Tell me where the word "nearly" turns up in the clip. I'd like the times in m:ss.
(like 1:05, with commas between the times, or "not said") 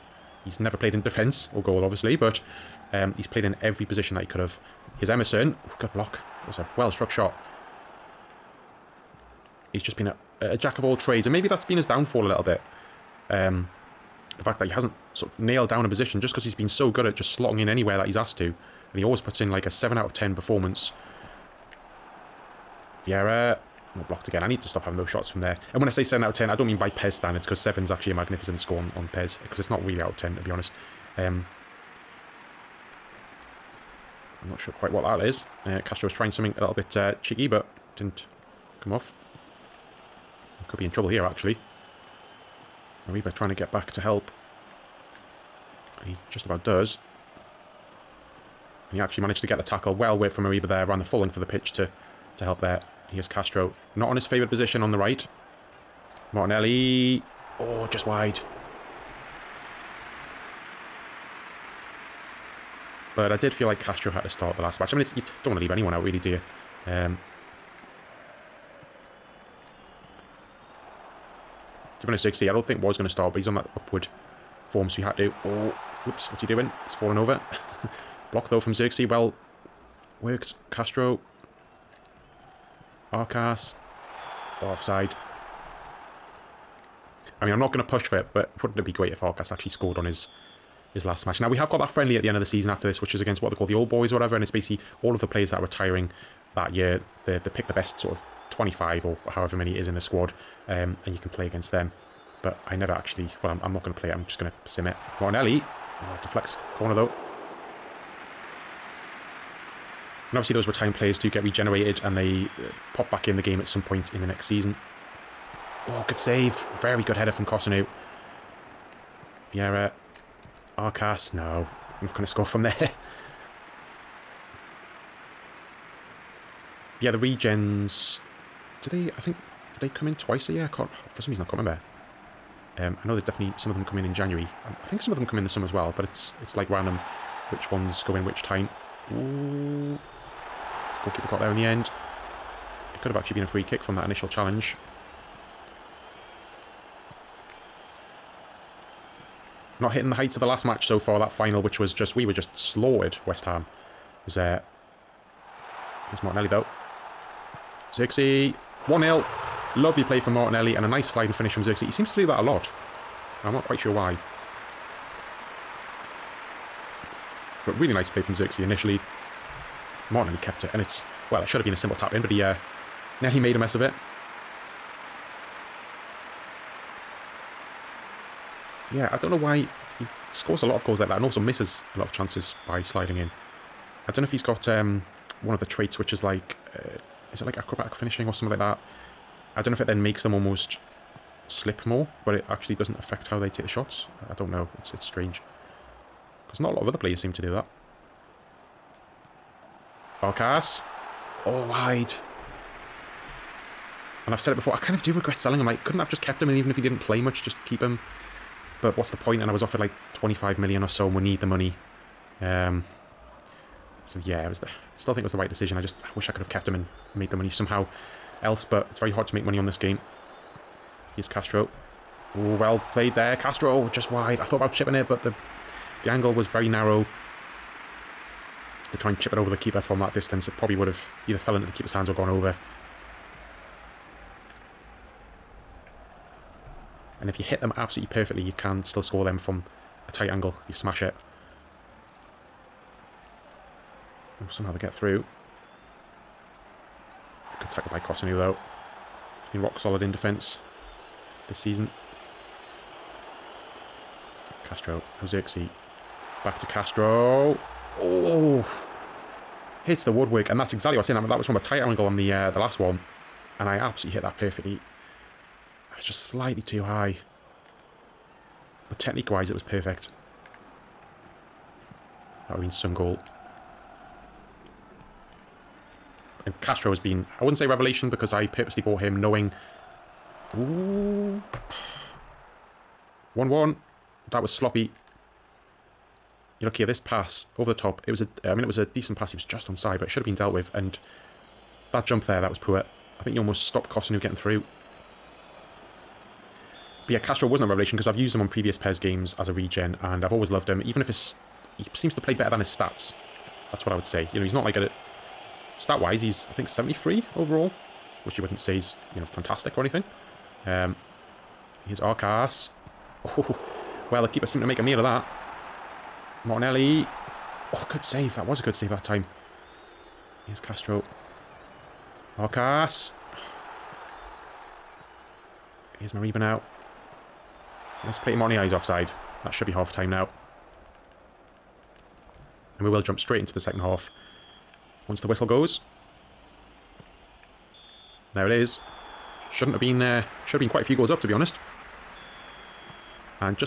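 2:53.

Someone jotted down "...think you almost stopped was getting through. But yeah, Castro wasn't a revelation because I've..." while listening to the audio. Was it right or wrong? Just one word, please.
right.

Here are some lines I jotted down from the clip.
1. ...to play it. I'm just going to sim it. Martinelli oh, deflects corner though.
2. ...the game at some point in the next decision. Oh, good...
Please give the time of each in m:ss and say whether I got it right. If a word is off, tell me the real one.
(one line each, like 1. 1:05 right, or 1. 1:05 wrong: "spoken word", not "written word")
1. 1:43 right
2. 1:53 wrong: "season", not "decision".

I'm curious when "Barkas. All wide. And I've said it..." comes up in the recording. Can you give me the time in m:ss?
3:20.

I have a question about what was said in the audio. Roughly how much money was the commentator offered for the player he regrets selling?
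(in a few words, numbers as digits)
25 million.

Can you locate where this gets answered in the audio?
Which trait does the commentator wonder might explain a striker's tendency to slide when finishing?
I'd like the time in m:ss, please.
3:07.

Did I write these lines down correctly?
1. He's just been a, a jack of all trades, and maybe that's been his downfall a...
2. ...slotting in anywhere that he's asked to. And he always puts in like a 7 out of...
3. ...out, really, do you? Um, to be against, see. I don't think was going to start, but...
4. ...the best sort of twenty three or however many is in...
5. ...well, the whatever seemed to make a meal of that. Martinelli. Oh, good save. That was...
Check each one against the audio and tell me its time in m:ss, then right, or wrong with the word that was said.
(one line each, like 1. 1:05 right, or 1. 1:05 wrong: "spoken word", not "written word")
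1. 0:09 right
2. 0:17 right
3. 1:05 wrong: "honest", not "against"
4. 1:37 wrong: "five", not "three"
5. 5:14 wrong: "keeper", not "whatever".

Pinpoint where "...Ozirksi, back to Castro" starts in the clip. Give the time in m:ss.
4:15.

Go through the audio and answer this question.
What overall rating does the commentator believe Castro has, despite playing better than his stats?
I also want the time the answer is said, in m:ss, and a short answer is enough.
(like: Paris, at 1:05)
73, at 5:06.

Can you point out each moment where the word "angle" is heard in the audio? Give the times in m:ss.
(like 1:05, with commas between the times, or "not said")
3:46, 4:00, 4:21.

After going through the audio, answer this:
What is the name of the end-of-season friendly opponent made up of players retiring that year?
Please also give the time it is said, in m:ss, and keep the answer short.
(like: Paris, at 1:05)
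the old boys, at 1:33.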